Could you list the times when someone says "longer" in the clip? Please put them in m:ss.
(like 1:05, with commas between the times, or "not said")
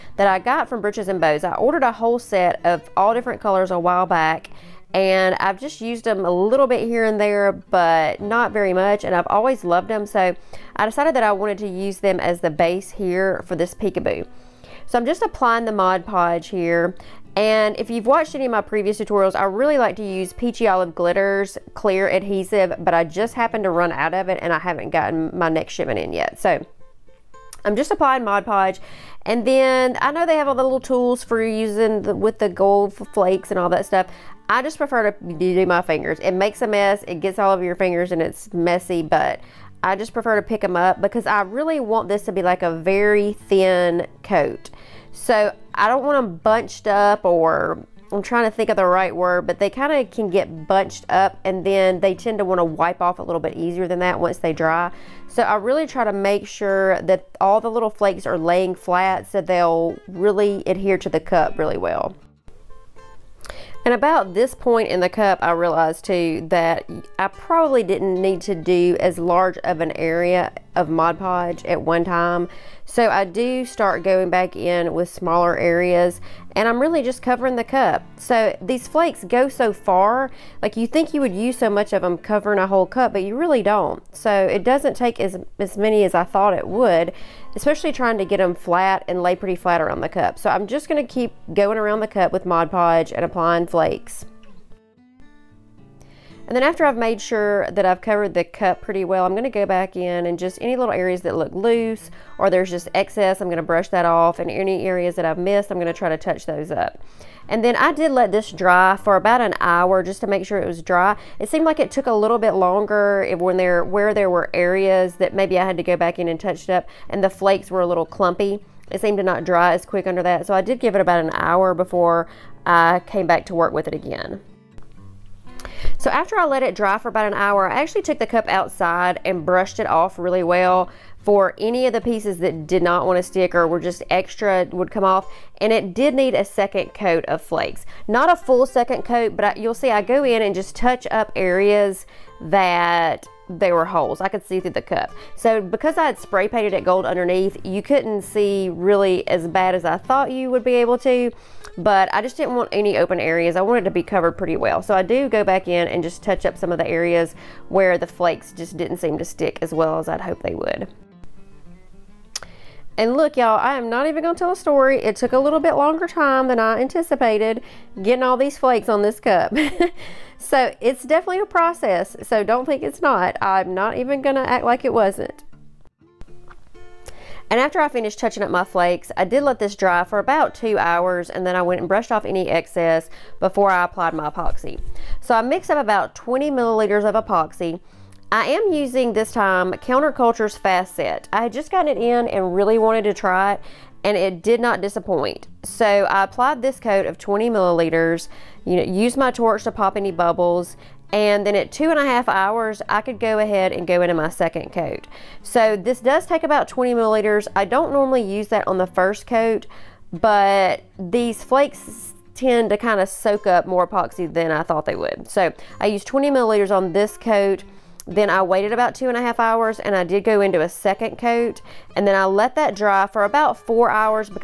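1:52, 2:45.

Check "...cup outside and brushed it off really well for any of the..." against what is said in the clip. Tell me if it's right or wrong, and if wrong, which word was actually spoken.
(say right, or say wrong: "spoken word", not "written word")
right.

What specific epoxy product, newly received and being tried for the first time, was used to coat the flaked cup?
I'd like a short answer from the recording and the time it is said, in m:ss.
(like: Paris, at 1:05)
Counterculture's Fast Set, at 3:09.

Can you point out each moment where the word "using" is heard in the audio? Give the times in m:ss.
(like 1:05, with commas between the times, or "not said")
0:31, 3:08.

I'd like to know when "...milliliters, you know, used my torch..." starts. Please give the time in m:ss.
3:17.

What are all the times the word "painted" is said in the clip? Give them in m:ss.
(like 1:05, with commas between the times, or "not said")
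2:26.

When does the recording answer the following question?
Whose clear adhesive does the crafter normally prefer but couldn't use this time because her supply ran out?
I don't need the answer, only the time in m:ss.
0:20.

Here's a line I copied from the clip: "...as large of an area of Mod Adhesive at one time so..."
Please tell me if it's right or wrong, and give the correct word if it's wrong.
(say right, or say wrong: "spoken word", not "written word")
wrong: "Podge", not "Adhesive".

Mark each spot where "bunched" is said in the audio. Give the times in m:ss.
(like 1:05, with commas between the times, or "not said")
0:46, 0:50.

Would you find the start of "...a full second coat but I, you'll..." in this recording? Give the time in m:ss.
2:18.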